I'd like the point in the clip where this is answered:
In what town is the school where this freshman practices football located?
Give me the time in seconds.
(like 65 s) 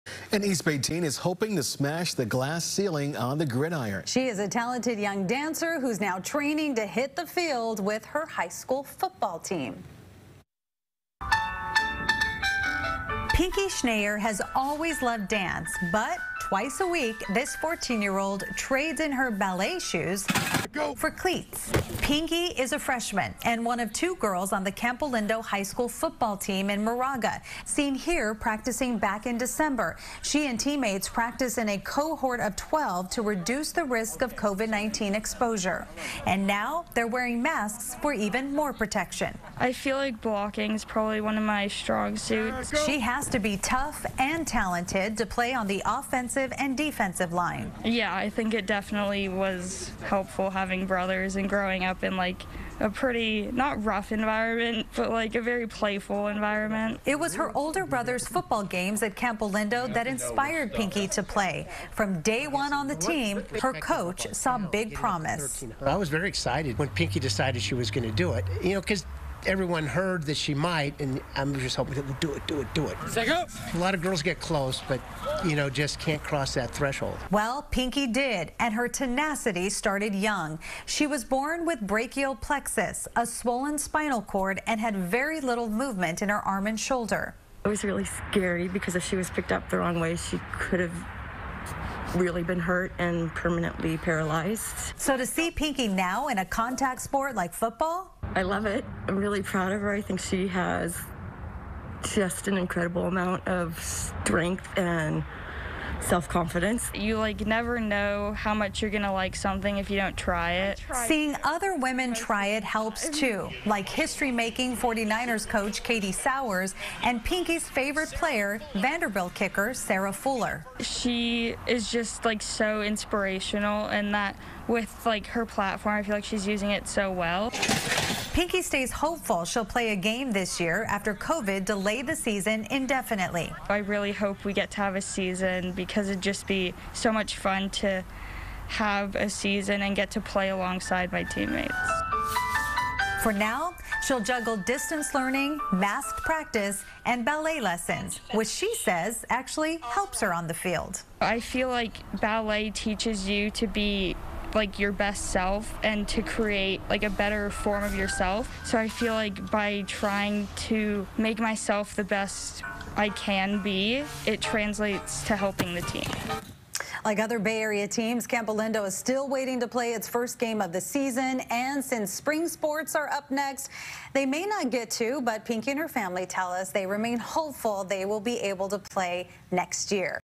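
26 s.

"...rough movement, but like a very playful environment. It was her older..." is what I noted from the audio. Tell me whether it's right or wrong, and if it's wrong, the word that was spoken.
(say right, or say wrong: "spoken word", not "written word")
wrong: "environment", not "movement".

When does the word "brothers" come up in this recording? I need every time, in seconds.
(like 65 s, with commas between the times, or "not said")
50 s, 57 s.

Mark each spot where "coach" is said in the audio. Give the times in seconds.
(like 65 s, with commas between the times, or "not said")
63 s, 115 s.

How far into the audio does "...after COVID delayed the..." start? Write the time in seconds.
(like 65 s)
130 s.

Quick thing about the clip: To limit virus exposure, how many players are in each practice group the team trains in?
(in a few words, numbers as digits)
12.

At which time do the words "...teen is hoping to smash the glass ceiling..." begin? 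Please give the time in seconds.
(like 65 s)
0 s.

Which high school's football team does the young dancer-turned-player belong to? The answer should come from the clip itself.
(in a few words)
Campolindo High School.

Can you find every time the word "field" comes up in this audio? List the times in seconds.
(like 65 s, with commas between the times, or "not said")
7 s, 150 s.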